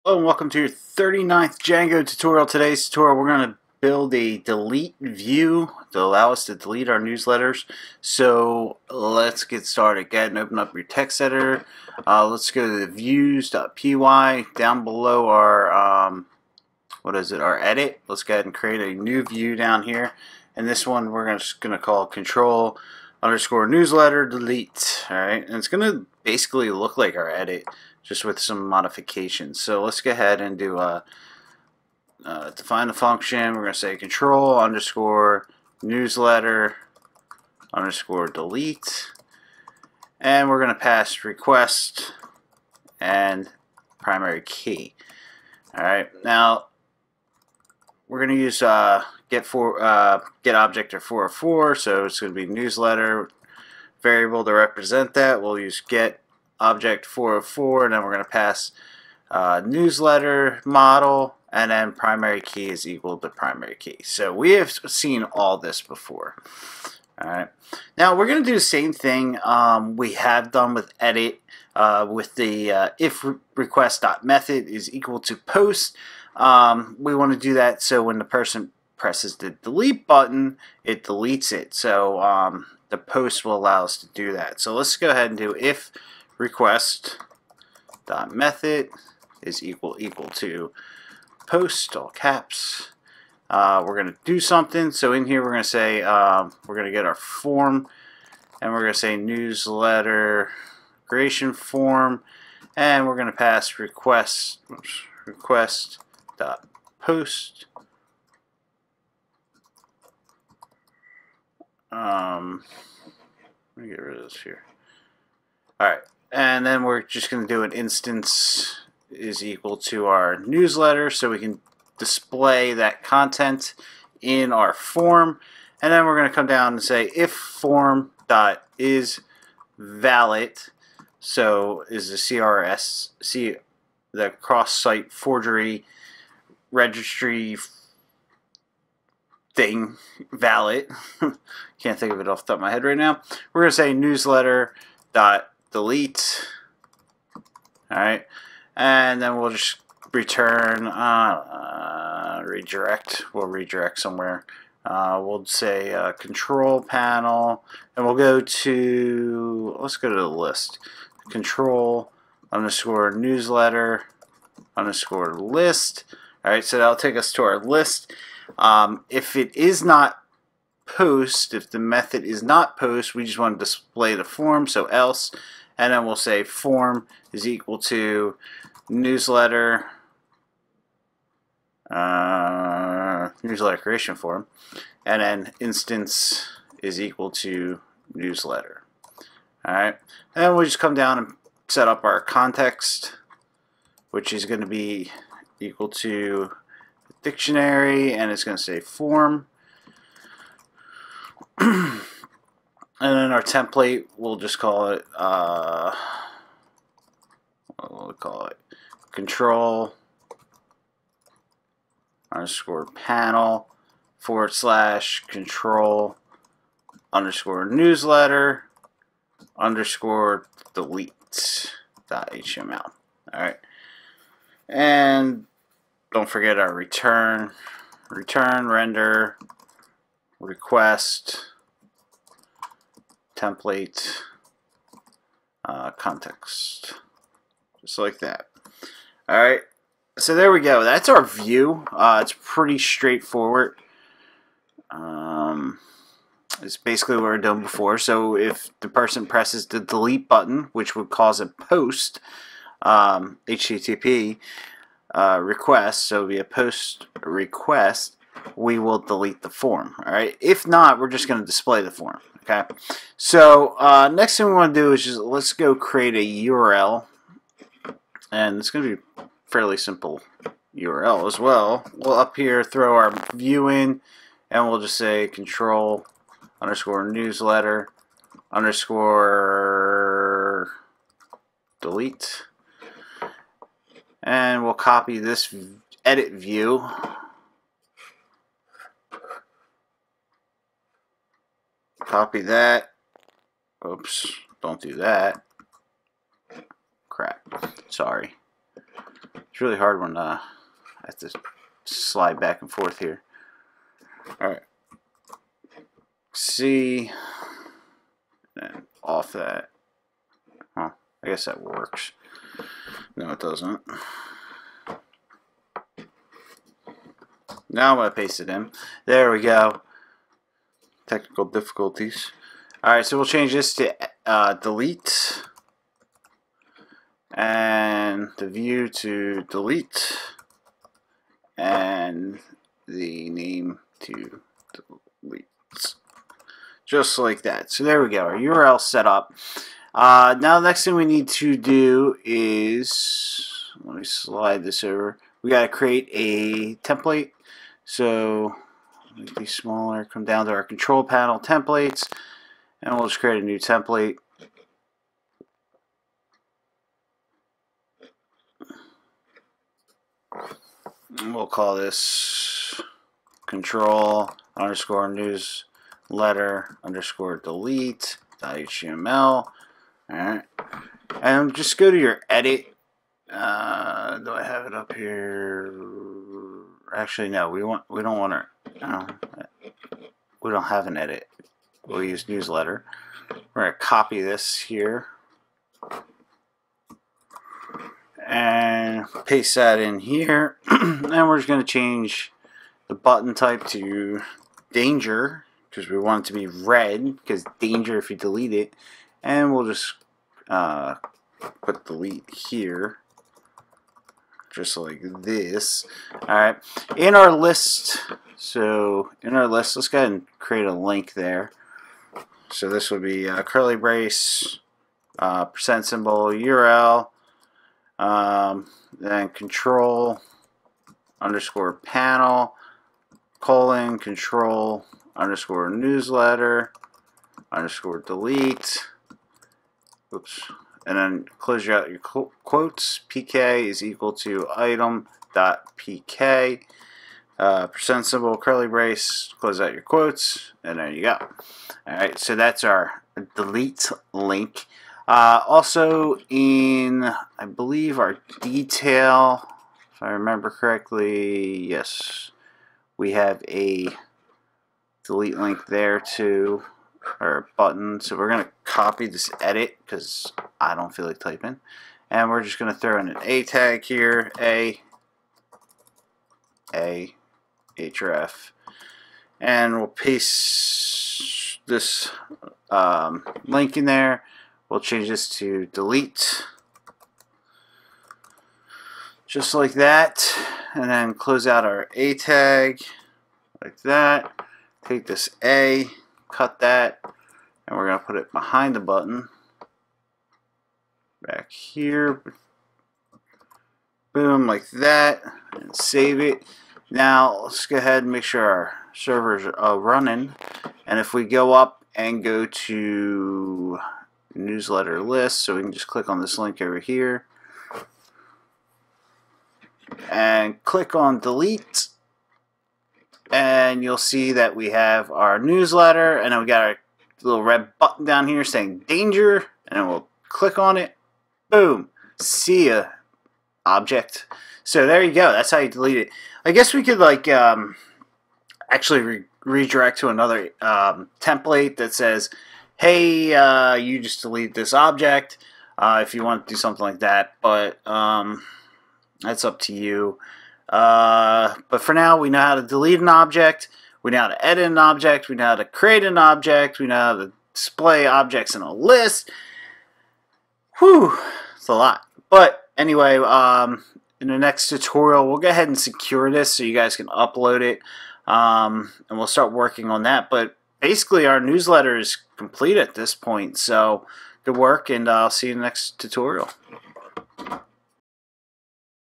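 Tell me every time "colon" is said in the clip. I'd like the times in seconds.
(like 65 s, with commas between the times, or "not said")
423 s.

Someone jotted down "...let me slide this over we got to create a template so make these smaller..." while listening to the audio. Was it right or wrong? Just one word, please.
right.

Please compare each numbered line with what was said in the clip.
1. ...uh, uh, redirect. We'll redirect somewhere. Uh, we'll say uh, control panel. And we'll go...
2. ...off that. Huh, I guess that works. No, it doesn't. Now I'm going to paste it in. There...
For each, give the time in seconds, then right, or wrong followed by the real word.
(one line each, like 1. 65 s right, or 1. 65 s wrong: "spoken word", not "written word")
1. 150 s right
2. 309 s right.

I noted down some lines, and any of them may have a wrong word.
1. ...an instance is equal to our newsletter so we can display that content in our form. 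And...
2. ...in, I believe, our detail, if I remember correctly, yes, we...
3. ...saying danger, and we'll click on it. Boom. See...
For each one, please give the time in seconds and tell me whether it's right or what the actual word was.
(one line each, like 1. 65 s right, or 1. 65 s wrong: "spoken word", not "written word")
1. 117 s right
2. 446 s right
3. 518 s right.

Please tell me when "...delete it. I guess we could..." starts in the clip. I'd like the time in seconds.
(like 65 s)
525 s.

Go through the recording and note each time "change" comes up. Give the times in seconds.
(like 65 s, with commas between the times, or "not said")
323 s, 391 s, 474 s.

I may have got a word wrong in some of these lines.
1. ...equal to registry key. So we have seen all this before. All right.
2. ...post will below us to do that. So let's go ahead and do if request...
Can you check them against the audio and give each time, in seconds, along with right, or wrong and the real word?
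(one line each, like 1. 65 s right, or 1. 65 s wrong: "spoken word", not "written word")
1. 62 s wrong: "primary", not "registry"
2. 82 s wrong: "allow", not "below".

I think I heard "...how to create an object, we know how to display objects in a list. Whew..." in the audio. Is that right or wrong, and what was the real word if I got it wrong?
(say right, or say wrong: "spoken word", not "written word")
right.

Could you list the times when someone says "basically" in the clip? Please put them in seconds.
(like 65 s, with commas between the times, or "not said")
26 s, 246 s, 560 s.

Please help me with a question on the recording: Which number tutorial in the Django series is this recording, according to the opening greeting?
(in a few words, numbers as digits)
39th.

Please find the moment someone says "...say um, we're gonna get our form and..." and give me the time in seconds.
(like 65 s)
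95 s.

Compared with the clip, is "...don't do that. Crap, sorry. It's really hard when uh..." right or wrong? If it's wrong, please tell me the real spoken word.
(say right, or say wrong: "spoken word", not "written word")
right.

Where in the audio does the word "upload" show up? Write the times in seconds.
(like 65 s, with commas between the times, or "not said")
557 s.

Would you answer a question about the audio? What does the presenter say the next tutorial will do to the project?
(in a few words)
secure.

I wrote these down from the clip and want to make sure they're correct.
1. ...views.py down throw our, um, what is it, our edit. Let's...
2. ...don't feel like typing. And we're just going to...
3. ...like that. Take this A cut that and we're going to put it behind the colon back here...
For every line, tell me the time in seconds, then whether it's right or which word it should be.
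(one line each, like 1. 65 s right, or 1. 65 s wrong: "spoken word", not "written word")
1. 12 s wrong: "below", not "throw"
2. 460 s right
3. 483 s wrong: "button", not "colon".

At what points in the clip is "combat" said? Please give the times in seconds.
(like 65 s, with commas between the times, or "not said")
not said.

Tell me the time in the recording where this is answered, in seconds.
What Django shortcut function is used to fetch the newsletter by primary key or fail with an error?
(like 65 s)
50 s.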